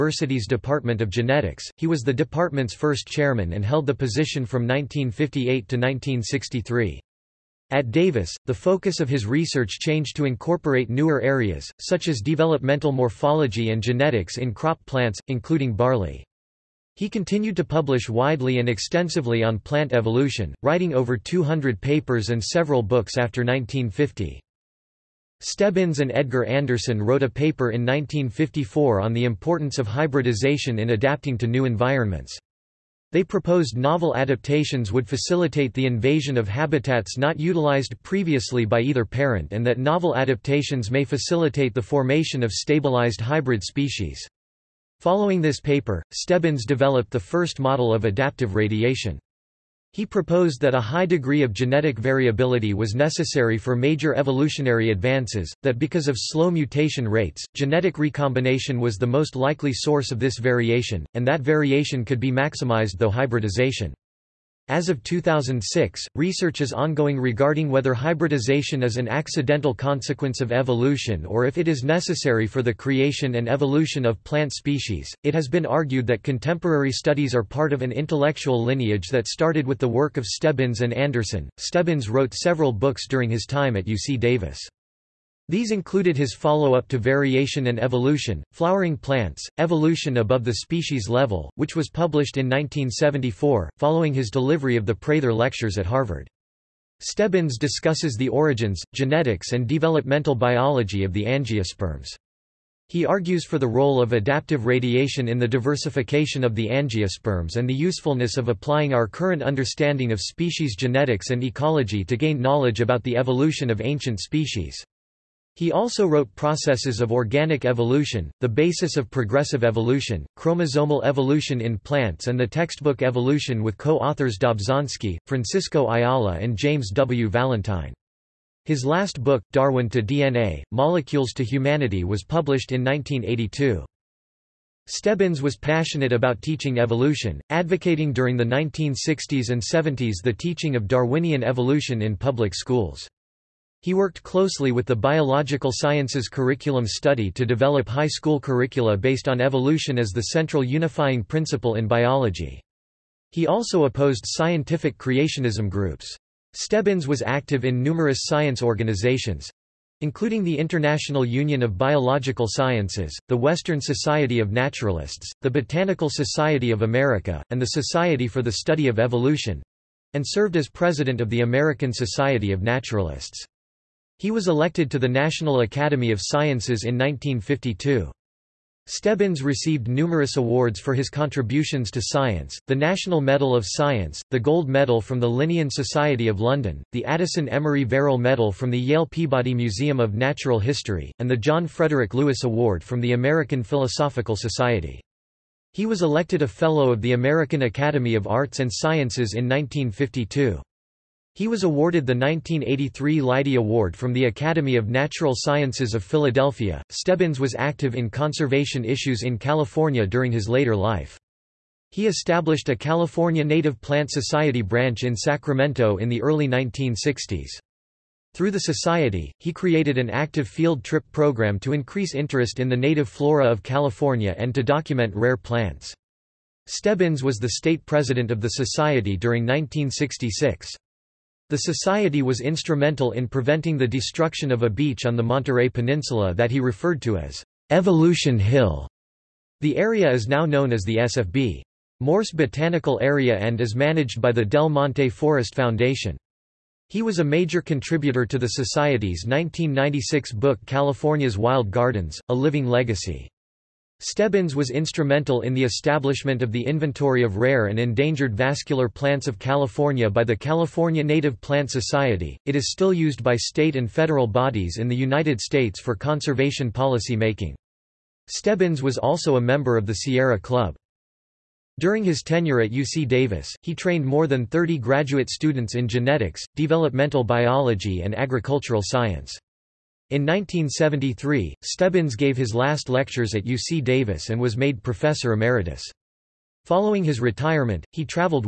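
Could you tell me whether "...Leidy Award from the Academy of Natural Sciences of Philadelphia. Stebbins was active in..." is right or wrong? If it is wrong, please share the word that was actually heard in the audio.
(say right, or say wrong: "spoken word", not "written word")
right.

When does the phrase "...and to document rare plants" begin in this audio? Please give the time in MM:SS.
03:44.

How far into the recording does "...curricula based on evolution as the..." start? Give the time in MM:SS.
02:28.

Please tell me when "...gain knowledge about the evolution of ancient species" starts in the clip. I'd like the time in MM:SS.
01:52.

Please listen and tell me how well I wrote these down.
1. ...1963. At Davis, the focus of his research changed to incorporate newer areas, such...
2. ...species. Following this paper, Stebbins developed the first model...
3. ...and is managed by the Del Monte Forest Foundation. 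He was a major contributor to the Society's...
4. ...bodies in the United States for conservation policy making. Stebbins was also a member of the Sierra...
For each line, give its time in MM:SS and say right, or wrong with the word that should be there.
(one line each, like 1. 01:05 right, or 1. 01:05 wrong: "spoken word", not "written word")
1. 00:05 right
2. 00:43 right
3. 04:03 right
4. 04:24 right.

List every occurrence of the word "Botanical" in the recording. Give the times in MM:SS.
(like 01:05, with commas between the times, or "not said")
02:45, 04:02.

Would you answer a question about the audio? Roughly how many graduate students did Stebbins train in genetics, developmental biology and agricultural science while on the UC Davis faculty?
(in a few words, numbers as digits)
more than 30.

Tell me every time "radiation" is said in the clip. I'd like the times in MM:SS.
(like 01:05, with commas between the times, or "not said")
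00:48, 01:44.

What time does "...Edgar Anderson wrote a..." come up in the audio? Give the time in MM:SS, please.
00:26.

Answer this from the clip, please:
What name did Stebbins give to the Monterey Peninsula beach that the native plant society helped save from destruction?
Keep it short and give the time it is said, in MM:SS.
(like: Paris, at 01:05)
Evolution Hill, at 03:57.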